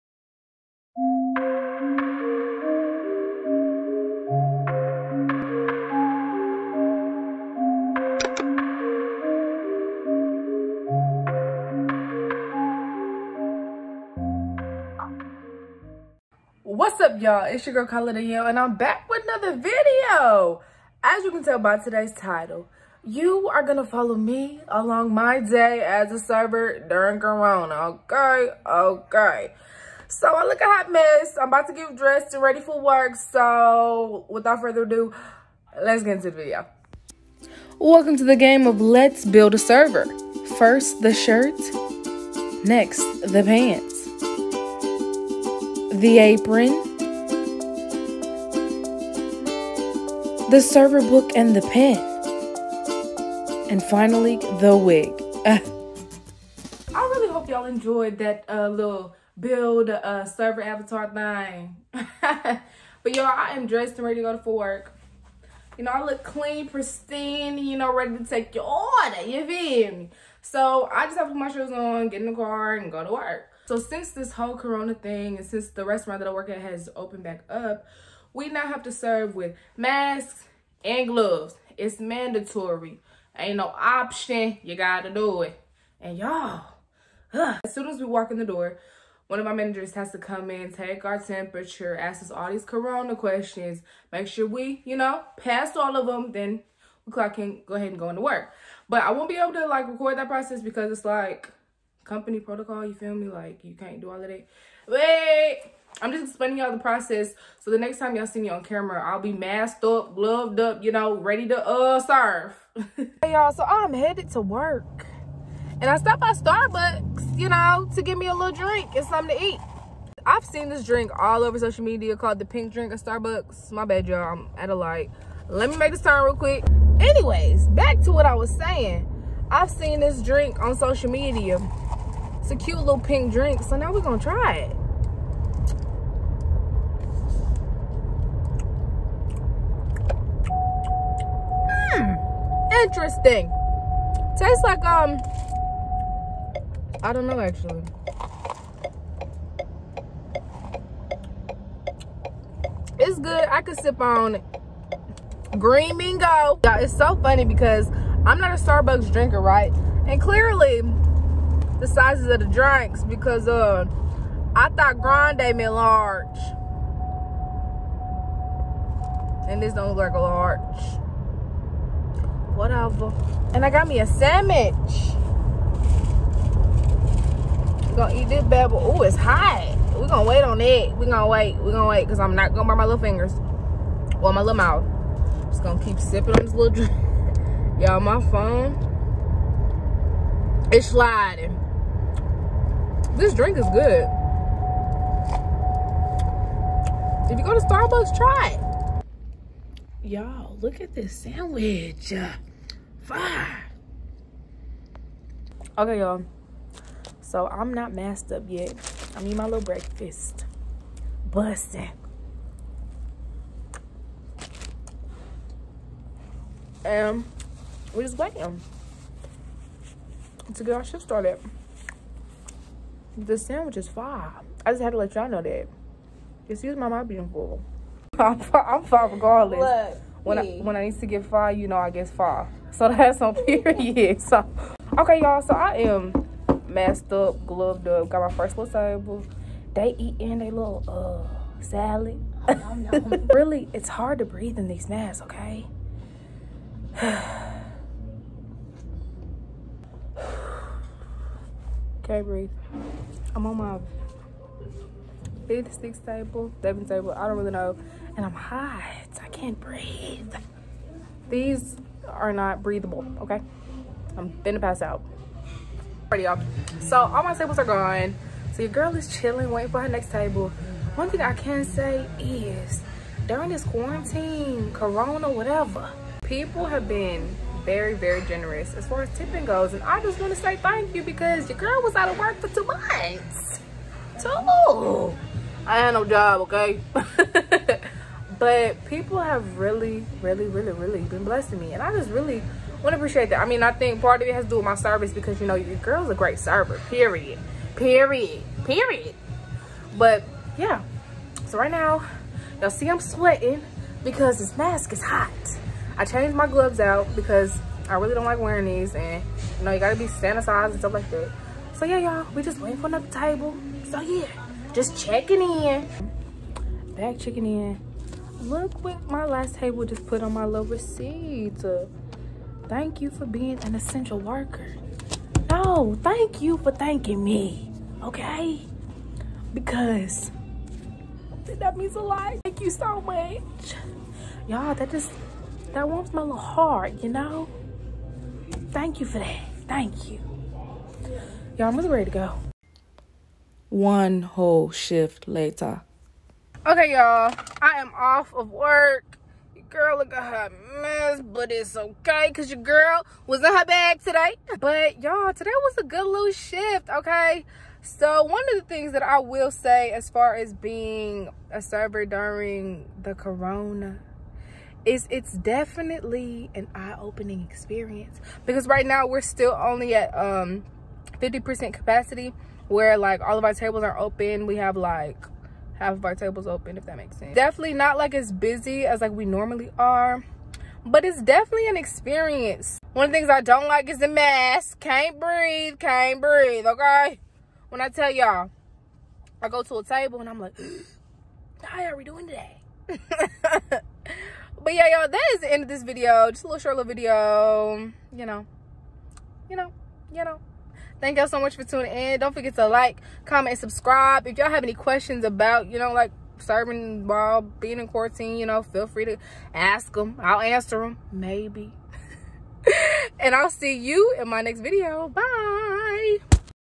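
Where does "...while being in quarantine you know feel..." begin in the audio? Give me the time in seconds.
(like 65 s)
407 s.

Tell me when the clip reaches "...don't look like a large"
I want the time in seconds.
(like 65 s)
169 s.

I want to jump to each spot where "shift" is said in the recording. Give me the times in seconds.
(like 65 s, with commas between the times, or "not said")
220 s, 344 s, 356 s.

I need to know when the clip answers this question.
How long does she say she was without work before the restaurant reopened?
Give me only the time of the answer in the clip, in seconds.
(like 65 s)
282 s.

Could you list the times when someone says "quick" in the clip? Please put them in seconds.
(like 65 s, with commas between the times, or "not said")
126 s.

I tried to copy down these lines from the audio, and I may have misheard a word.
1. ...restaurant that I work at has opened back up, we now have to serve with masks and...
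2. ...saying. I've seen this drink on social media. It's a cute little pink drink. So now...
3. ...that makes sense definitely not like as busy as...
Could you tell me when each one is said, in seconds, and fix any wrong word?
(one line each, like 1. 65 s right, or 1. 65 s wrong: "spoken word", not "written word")
1. 75 s right
2. 128 s right
3. 376 s right.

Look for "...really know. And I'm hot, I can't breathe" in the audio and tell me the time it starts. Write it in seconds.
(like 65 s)
257 s.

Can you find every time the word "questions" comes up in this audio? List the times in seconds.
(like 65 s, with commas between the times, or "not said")
93 s, 404 s.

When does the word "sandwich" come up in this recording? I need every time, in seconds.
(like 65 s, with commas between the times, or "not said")
174 s, 201 s, 223 s.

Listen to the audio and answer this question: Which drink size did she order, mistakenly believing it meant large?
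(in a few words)
grande.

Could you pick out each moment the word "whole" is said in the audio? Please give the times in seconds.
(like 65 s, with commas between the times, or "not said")
74 s, 344 s.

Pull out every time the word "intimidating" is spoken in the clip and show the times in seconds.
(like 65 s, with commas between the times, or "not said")
not said.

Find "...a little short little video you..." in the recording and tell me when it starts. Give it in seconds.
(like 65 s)
396 s.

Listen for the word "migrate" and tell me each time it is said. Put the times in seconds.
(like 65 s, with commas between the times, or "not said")
not said.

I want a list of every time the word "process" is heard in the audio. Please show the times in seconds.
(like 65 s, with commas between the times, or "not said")
100 s, 106 s.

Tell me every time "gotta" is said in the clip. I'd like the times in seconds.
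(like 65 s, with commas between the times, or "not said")
84 s, 309 s.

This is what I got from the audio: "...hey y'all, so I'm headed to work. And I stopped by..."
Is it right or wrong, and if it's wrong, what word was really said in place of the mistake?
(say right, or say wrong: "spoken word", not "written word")
right.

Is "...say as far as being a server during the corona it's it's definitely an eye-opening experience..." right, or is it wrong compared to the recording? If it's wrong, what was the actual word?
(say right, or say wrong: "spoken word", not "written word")
right.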